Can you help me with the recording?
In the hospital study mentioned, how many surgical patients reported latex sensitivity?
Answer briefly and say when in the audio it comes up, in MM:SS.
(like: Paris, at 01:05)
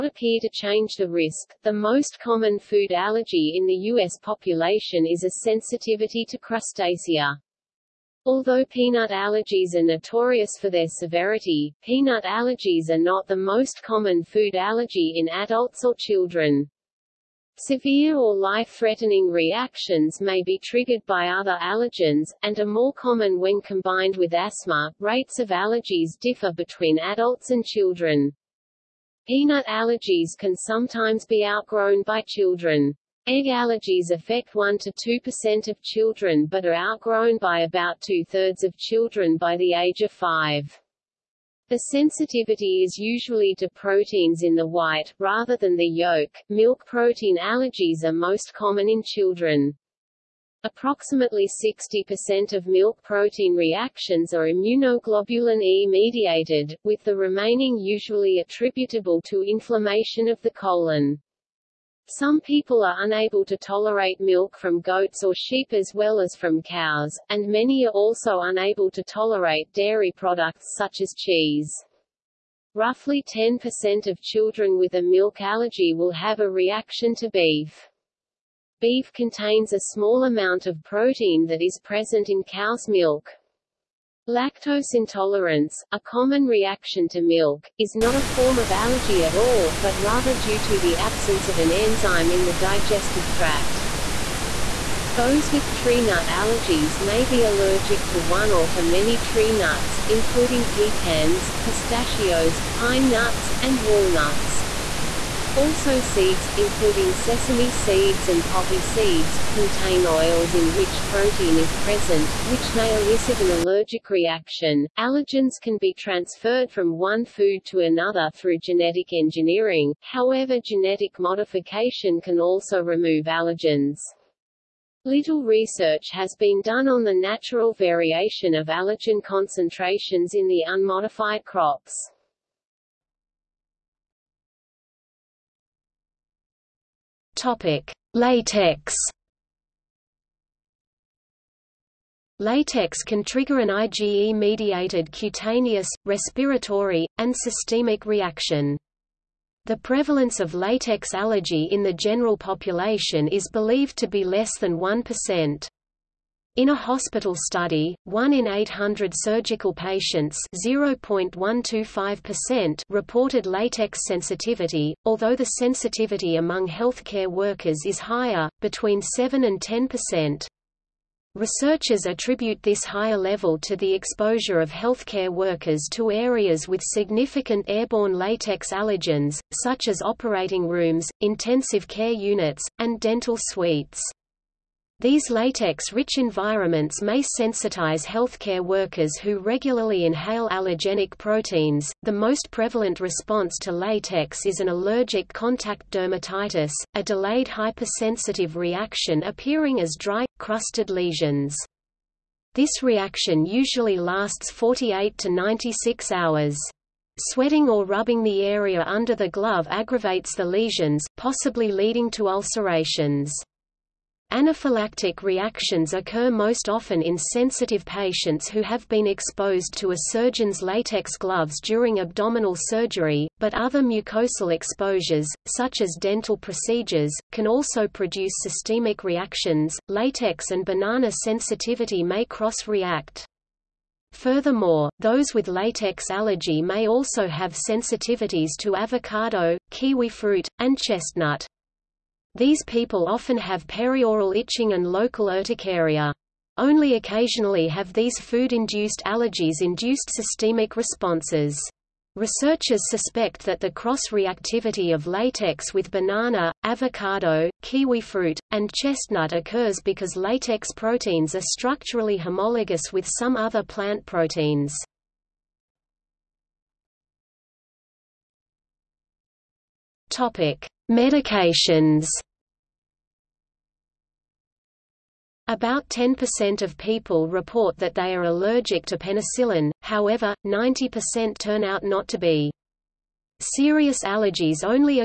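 1 in 800, at 02:38.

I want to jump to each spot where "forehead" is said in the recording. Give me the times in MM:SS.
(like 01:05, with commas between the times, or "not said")
not said.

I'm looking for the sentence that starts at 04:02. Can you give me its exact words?
These people often have perioral itching and local urticaria.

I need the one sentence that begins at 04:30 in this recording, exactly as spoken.
Topic: Medications About 10% of people report that they are allergic to penicillin, however, 90% turn out not to be.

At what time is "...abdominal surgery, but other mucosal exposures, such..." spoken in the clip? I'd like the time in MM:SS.
03:41.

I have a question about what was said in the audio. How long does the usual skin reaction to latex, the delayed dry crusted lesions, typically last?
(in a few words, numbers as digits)
48 to 96 hours.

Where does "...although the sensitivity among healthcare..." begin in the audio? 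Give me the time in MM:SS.
02:45.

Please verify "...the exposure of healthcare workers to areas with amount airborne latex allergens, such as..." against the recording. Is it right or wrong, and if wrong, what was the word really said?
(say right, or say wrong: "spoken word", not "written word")
wrong: "significant", not "amount".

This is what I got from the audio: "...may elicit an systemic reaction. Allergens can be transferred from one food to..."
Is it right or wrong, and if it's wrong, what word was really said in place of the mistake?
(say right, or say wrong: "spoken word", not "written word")
wrong: "allergic", not "systemic".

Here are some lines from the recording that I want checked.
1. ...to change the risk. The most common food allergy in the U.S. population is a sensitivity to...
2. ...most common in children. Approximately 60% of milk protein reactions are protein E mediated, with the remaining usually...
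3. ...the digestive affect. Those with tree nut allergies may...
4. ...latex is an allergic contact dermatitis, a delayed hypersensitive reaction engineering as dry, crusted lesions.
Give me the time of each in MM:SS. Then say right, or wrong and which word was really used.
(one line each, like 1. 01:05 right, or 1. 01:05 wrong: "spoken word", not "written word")
1. 00:00 right
2. 00:48 wrong: "immunoglobulin", not "protein"
3. 01:32 wrong: "tract", not "affect"
4. 03:13 wrong: "appearing", not "engineering".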